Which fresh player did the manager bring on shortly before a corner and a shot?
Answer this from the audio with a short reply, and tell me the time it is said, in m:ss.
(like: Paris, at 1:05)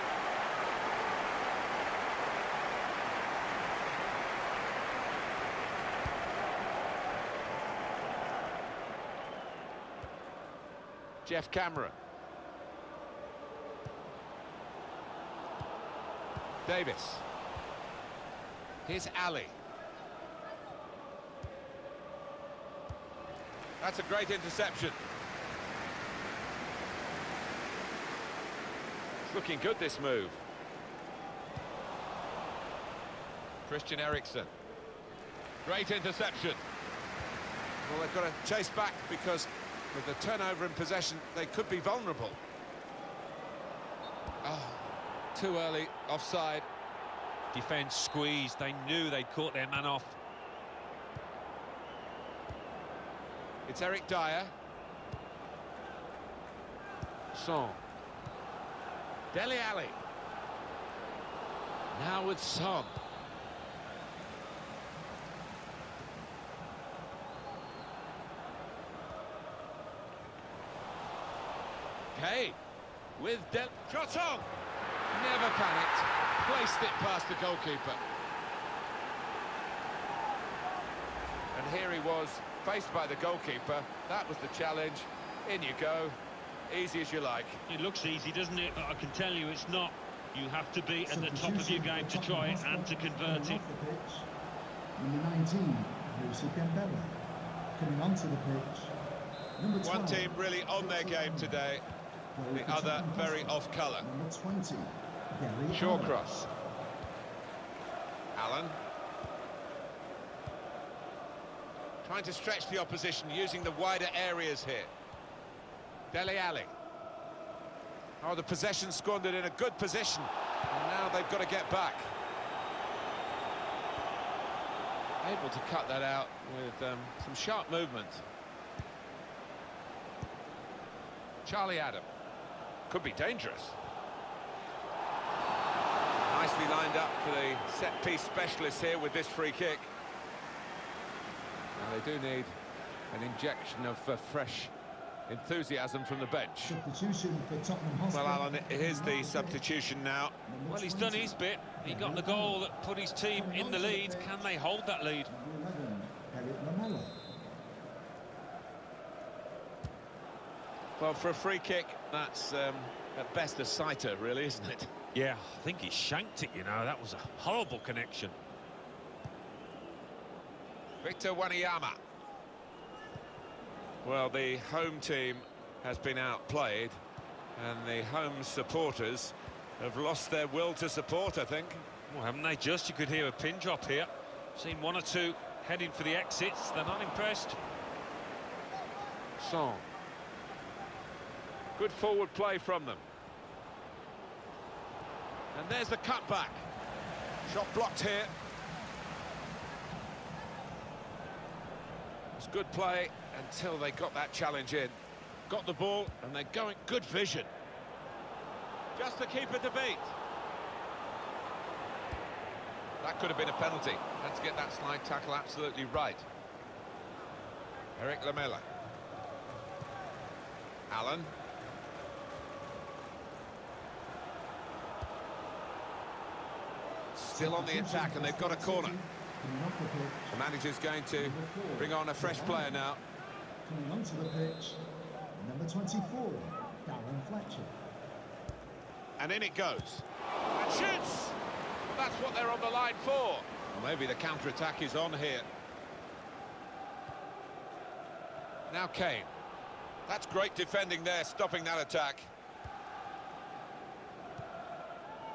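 Darren Fletcher, at 3:56.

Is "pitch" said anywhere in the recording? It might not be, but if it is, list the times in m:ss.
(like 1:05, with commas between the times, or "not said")
1:38, 3:54.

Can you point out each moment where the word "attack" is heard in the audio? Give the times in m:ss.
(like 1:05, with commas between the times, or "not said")
3:47, 4:04, 4:11.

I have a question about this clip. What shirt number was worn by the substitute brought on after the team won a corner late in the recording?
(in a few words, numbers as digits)
24.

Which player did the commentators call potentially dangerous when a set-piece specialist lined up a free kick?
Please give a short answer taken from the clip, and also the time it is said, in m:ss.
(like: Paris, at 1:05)
Charlie Adam, at 2:11.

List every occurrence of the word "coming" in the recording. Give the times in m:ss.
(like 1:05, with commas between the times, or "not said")
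1:36, 3:53.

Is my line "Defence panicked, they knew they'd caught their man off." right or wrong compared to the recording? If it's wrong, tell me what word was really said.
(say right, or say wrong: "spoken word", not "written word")
wrong: "squeezed", not "panicked".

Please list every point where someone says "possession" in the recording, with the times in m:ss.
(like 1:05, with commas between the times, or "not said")
0:40, 1:58.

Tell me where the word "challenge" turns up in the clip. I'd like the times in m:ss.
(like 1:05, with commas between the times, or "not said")
1:24, 3:24.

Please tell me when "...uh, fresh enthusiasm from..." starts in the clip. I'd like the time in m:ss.
2:24.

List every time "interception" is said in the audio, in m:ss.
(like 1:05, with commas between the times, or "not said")
0:24, 0:35.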